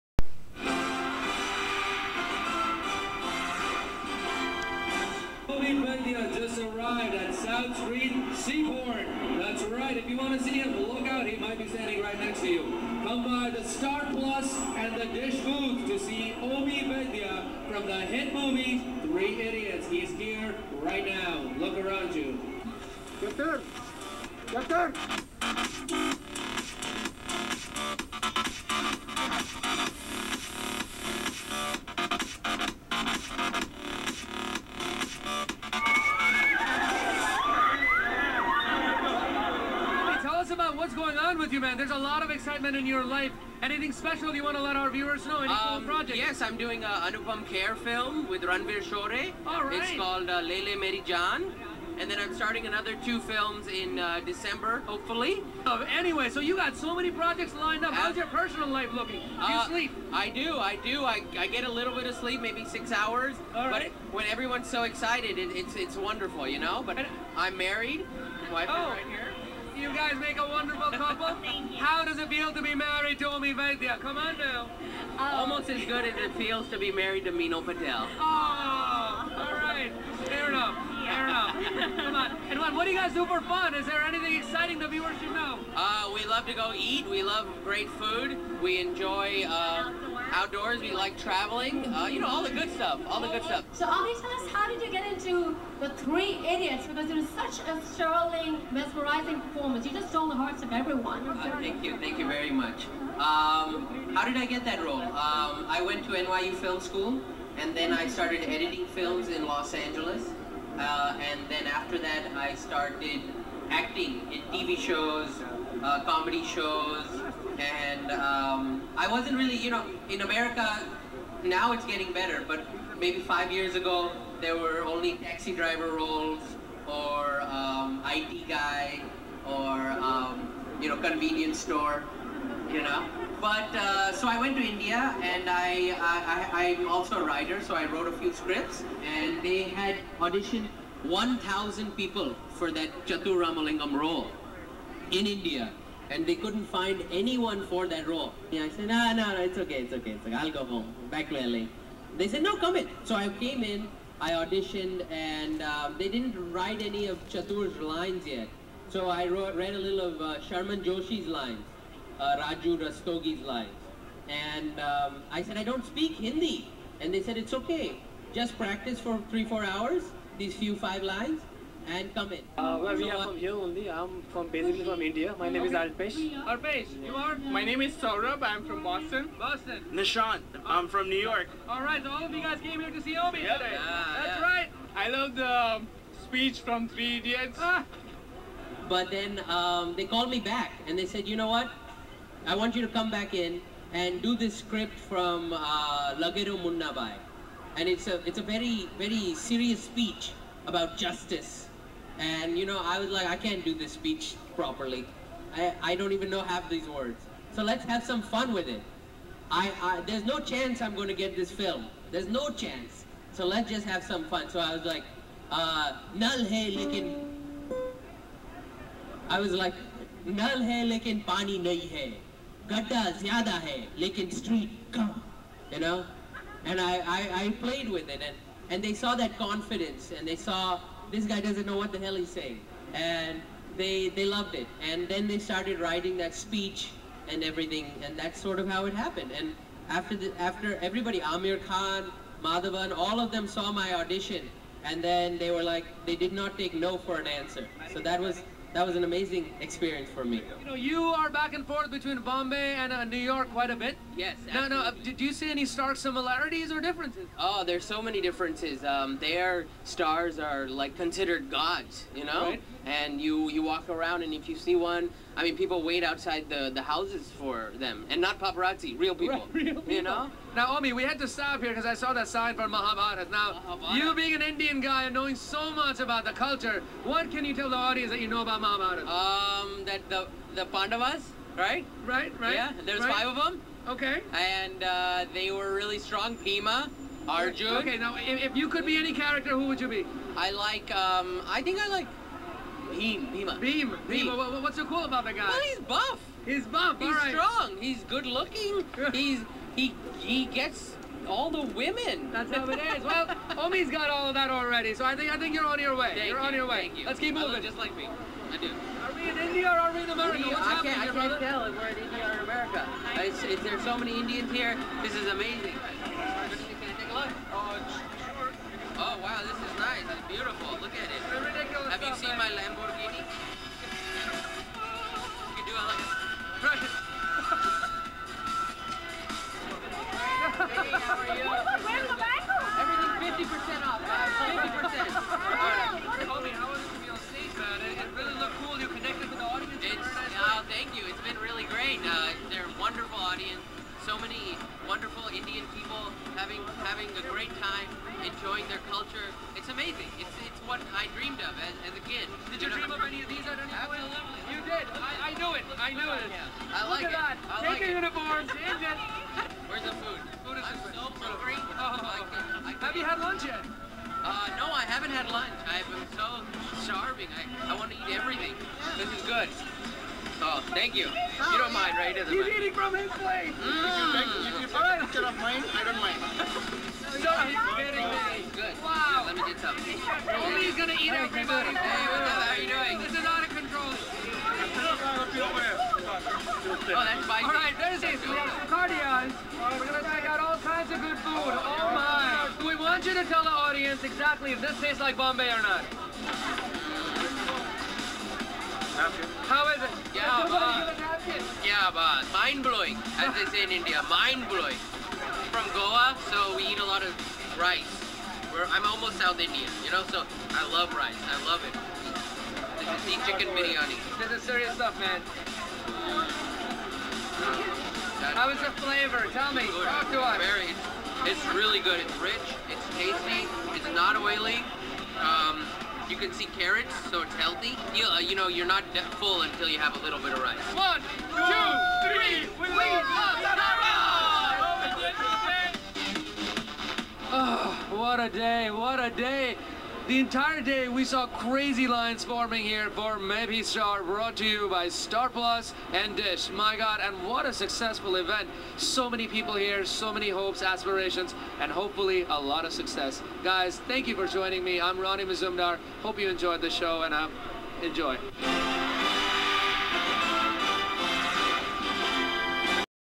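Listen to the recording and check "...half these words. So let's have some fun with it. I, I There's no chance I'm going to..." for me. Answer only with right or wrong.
right.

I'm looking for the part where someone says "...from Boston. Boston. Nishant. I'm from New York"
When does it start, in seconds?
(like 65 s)
178 s.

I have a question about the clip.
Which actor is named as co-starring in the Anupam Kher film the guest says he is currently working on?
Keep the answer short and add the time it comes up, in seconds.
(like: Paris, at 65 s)
Ranvir Shorey, at 48 s.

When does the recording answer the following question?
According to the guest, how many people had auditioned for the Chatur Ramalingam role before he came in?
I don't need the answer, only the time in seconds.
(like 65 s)
141 s.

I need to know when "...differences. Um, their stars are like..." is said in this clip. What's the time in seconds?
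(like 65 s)
258 s.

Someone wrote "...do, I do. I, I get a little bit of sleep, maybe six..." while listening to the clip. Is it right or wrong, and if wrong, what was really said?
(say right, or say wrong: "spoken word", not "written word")
right.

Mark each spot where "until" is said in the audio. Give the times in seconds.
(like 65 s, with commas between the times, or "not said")
429 s.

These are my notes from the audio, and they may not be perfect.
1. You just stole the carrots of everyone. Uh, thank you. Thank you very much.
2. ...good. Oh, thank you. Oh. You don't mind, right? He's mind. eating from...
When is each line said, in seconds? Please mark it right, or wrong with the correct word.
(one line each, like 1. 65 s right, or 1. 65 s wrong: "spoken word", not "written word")
1. 99 s wrong: "hearts", not "carrots"
2. 369 s right.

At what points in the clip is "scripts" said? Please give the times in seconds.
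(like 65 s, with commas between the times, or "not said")
138 s, 194 s.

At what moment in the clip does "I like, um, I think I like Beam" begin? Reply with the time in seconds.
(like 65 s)
290 s.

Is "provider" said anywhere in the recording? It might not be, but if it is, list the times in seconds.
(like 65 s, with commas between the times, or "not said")
not said.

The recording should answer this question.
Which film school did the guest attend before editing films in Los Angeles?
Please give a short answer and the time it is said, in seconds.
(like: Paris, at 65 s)
NYU Film School, at 106 s.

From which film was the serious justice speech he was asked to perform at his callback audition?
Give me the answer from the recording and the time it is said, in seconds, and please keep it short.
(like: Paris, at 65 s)
Lage Raho Munna Bhai, at 196 s.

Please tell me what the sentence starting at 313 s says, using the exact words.
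It's, it's, there's so many Indians here.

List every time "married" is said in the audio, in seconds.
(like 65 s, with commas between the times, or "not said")
67 s, 72 s, 76 s.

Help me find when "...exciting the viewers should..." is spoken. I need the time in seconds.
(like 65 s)
84 s.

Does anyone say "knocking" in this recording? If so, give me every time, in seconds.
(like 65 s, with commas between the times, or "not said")
not said.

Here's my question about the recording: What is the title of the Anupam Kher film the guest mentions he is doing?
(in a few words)
Lele Meri Jaan.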